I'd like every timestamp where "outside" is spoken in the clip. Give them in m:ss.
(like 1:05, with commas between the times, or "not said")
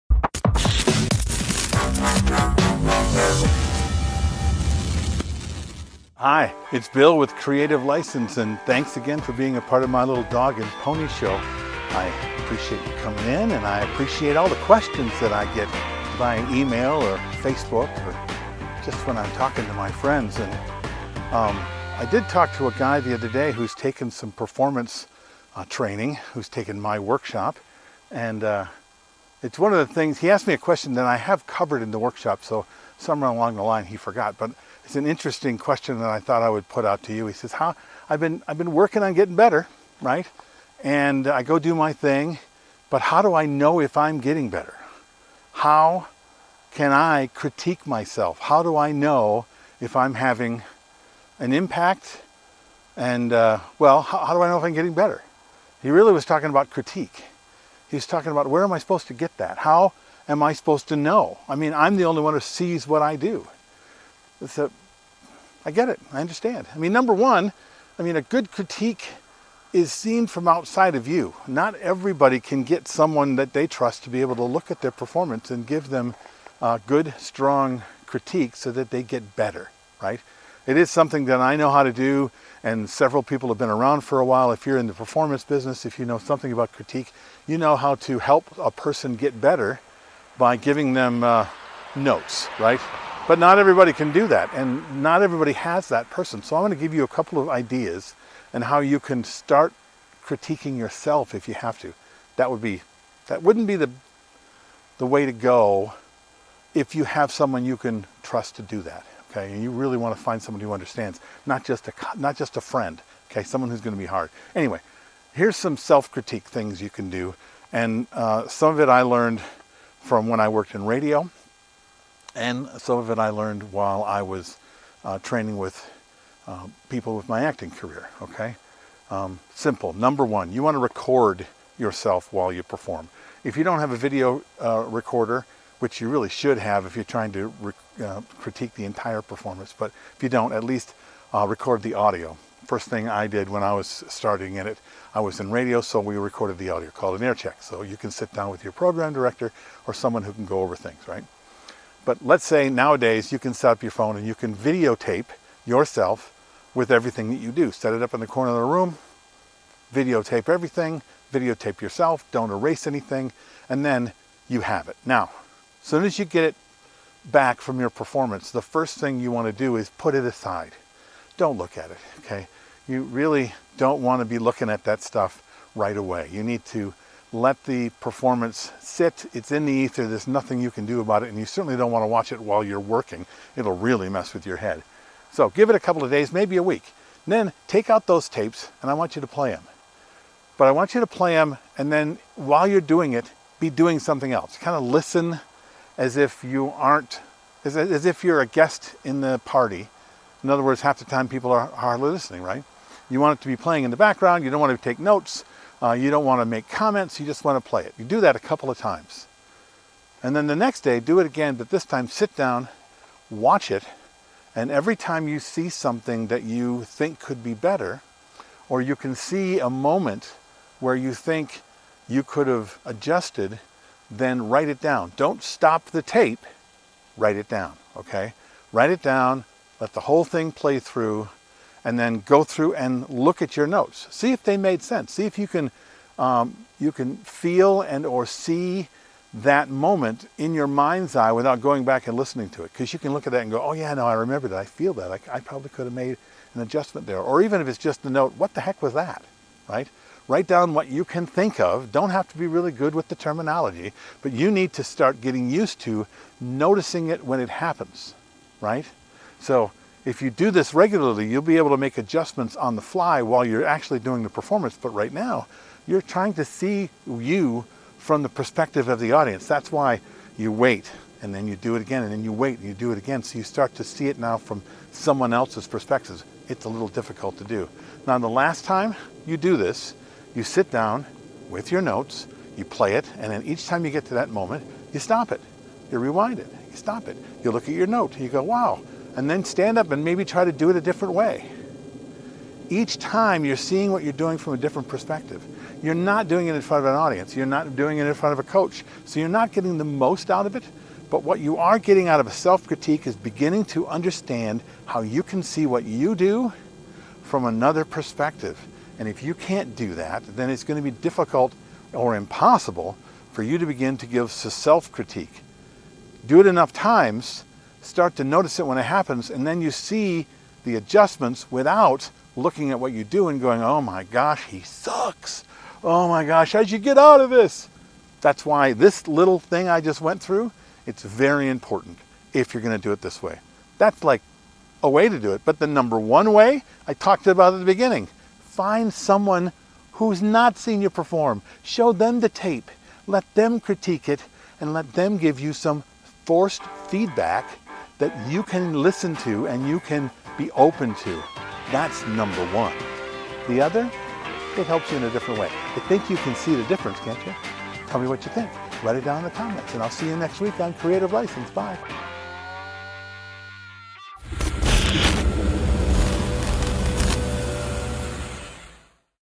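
1:10.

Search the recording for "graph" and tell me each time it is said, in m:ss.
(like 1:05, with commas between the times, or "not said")
not said.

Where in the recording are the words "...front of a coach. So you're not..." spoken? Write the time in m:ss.
4:58.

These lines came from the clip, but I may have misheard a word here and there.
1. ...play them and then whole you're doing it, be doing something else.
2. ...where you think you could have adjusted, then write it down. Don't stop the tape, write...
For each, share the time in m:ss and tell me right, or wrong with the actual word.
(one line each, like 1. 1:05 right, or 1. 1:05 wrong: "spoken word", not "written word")
1. 3:11 wrong: "while", not "whole"
2. 3:40 right.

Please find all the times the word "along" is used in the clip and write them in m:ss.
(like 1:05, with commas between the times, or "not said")
0:33.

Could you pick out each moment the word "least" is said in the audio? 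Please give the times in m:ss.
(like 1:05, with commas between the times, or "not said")
2:20.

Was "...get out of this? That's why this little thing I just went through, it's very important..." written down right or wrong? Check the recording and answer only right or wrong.
right.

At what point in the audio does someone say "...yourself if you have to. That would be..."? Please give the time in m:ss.
1:40.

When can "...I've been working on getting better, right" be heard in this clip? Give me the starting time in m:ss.
0:38.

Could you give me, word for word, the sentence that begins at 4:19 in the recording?
So if you do this regularly, you'll be able to make adjustments on the fly while you're actually doing the performance.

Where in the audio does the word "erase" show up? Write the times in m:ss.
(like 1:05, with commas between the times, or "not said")
2:42.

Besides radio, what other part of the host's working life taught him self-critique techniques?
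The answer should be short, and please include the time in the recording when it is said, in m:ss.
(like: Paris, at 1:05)
acting career, at 2:07.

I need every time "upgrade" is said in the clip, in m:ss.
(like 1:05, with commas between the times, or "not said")
not said.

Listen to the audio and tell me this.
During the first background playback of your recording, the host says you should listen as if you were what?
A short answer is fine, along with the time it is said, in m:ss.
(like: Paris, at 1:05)
a guest in the party, at 3:18.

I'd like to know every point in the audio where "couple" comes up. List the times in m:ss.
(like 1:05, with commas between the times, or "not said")
1:37, 3:05, 3:28.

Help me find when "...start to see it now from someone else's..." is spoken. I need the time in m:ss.
4:33.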